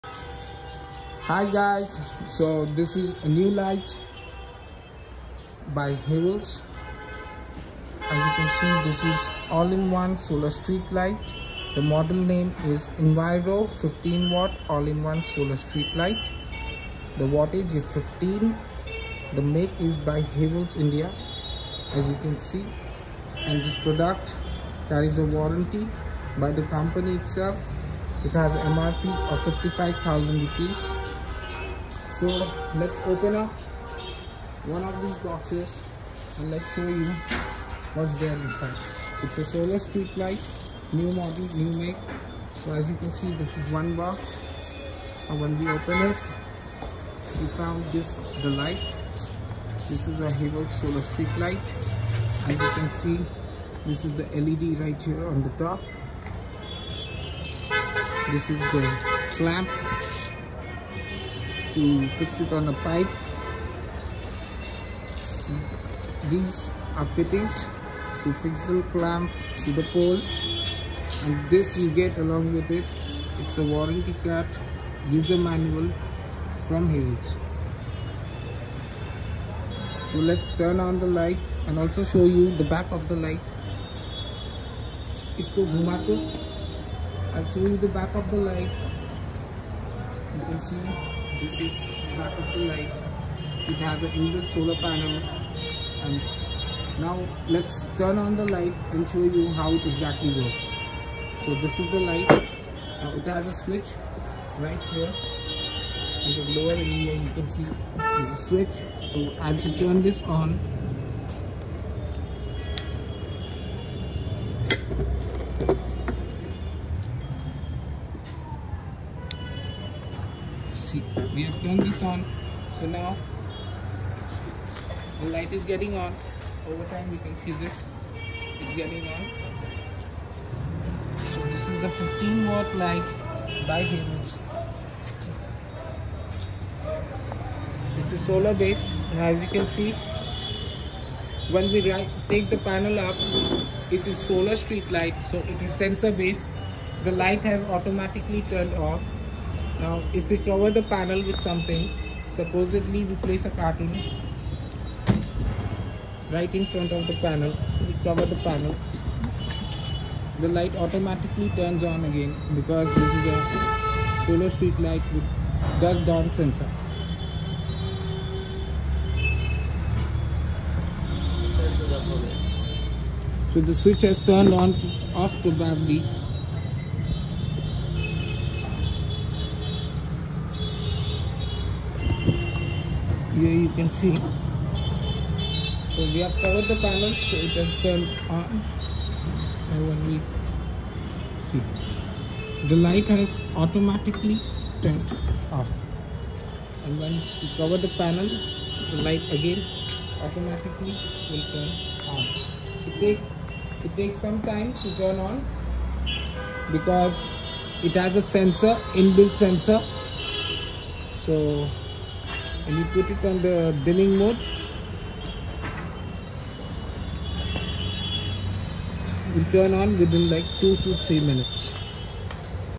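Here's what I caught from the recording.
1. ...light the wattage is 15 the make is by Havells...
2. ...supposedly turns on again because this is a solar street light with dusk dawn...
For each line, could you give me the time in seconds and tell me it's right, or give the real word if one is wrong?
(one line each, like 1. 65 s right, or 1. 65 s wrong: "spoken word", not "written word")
1. 15 s right
2. 160 s wrong: "automatically", not "supposedly".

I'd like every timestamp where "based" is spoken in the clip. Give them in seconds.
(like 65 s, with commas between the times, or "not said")
138 s, 146 s.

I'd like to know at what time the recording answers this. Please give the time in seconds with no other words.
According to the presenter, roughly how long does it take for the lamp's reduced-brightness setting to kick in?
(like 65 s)
220 s.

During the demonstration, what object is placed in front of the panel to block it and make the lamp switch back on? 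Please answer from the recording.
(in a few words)
a carton.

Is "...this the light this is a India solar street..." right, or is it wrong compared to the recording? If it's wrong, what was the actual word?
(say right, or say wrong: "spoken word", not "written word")
wrong: "Havells", not "India".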